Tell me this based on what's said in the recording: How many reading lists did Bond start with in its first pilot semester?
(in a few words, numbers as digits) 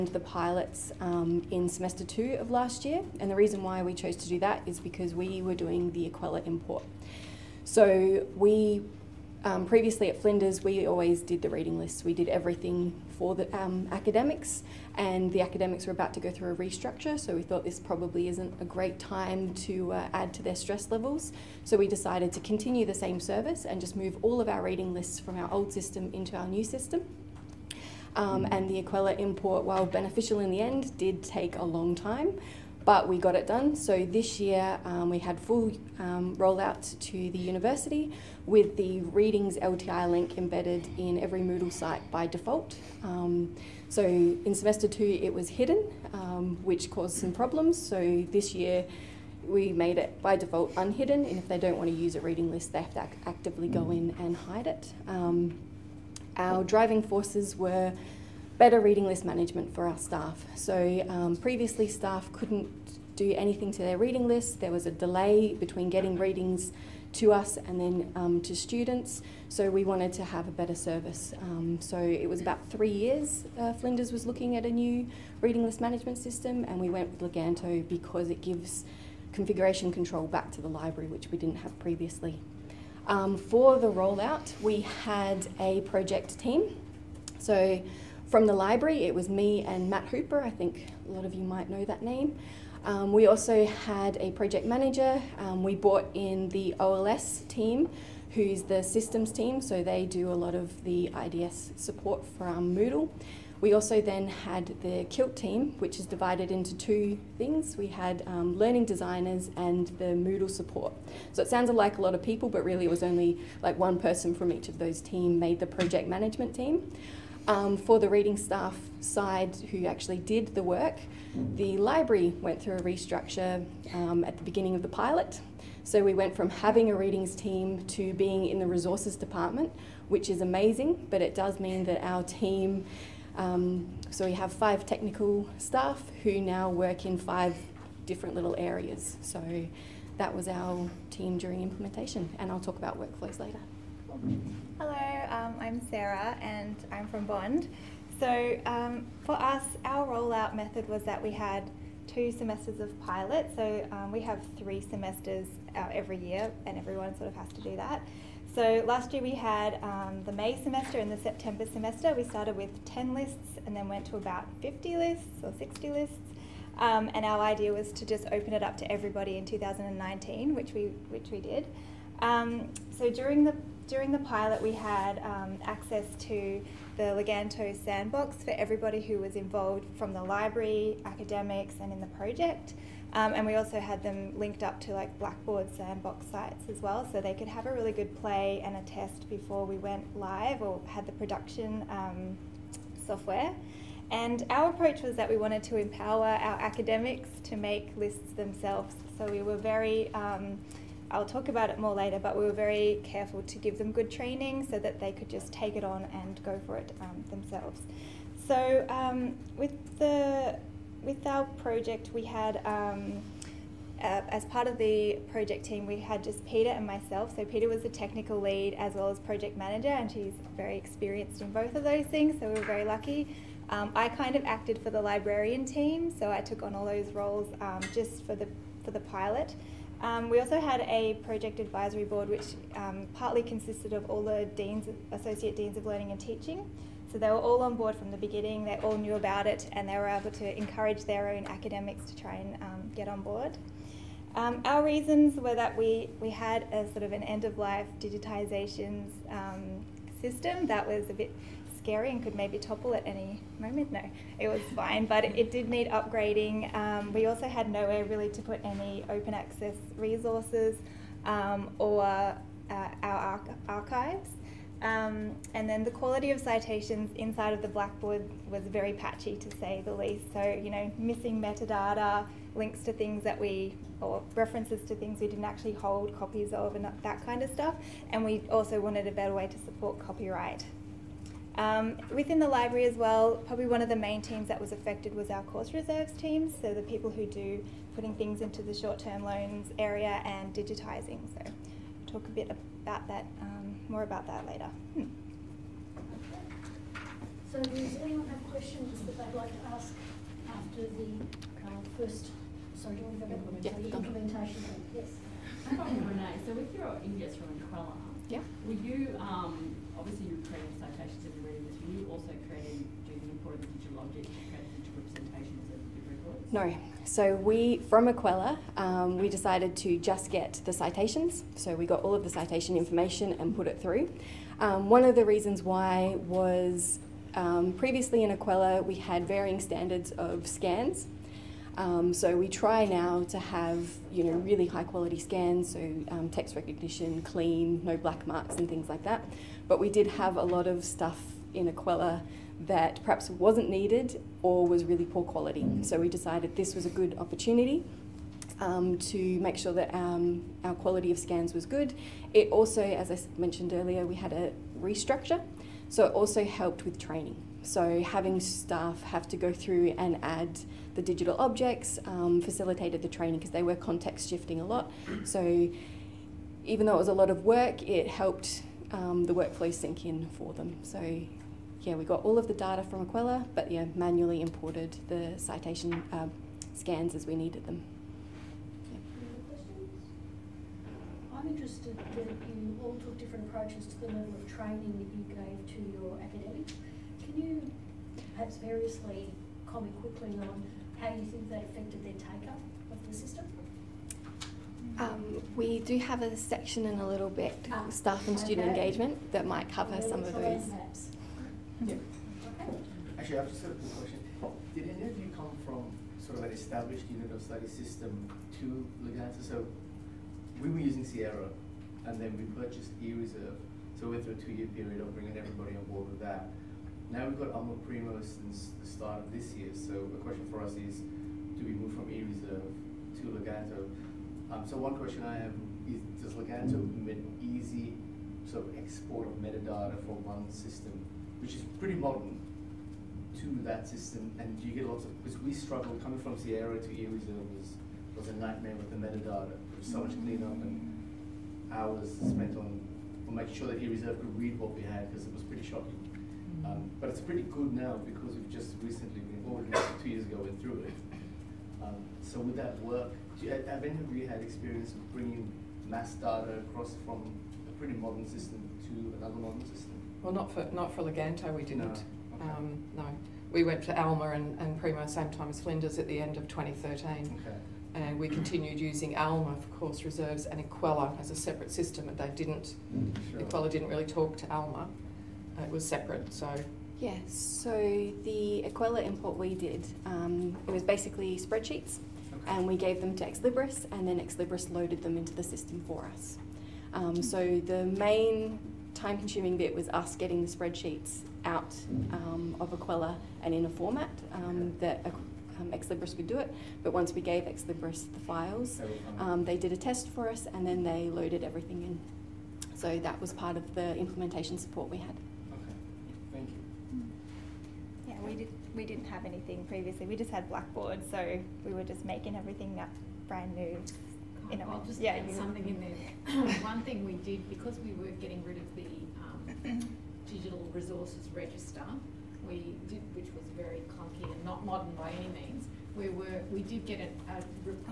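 10.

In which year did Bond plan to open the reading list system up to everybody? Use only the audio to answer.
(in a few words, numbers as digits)
2019.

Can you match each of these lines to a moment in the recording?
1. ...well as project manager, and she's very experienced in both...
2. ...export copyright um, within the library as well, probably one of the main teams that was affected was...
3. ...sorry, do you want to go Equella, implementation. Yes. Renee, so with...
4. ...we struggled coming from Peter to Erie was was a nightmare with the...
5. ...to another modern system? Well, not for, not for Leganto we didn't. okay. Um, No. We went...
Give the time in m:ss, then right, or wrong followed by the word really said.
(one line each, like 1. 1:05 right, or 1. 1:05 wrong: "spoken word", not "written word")
1. 3:38 right
2. 4:39 wrong: "support", not "export"
3. 5:02 wrong: "Yeah", not "Equella"
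4. 7:15 wrong: "Sierra", not "Peter"
5. 7:38 right.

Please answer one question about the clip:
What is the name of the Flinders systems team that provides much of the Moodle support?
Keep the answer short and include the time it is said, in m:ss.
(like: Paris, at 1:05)
OLS team, at 1:36.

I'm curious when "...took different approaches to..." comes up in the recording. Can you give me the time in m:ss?
6:22.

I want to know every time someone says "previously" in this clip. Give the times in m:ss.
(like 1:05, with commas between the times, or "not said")
0:09, 1:01, 1:21, 5:27, 8:29.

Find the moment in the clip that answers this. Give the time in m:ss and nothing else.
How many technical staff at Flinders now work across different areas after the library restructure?
2:14.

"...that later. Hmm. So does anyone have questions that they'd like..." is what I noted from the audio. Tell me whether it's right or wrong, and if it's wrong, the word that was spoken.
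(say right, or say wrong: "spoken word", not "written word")
right.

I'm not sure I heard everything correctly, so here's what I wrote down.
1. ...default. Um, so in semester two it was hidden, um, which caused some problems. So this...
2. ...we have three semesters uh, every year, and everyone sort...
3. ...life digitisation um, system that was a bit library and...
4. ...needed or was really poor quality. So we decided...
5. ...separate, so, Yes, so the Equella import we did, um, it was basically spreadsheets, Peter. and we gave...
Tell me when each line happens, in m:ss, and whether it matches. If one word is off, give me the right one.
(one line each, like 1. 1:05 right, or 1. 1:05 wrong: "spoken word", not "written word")
1. 0:42 right
2. 2:34 right
3. 4:07 wrong: "scary", not "library"
4. 5:43 right
5. 7:55 wrong: "Okay", not "Peter".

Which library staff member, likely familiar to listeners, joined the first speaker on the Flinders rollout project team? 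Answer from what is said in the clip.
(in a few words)
Matt Hooper.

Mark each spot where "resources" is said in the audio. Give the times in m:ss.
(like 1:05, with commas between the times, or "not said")
2:08, 4:19, 8:40.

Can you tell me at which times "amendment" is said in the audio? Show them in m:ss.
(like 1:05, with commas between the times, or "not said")
not said.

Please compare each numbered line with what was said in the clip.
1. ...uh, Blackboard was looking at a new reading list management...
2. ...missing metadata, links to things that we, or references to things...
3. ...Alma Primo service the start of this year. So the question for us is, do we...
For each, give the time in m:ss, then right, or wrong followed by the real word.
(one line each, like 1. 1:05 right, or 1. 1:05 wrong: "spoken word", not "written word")
1. 1:13 wrong: "Flinders", not "Blackboard"
2. 4:30 right
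3. 6:57 wrong: "since", not "service".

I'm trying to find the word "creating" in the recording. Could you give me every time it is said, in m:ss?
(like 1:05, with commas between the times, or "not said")
5:10.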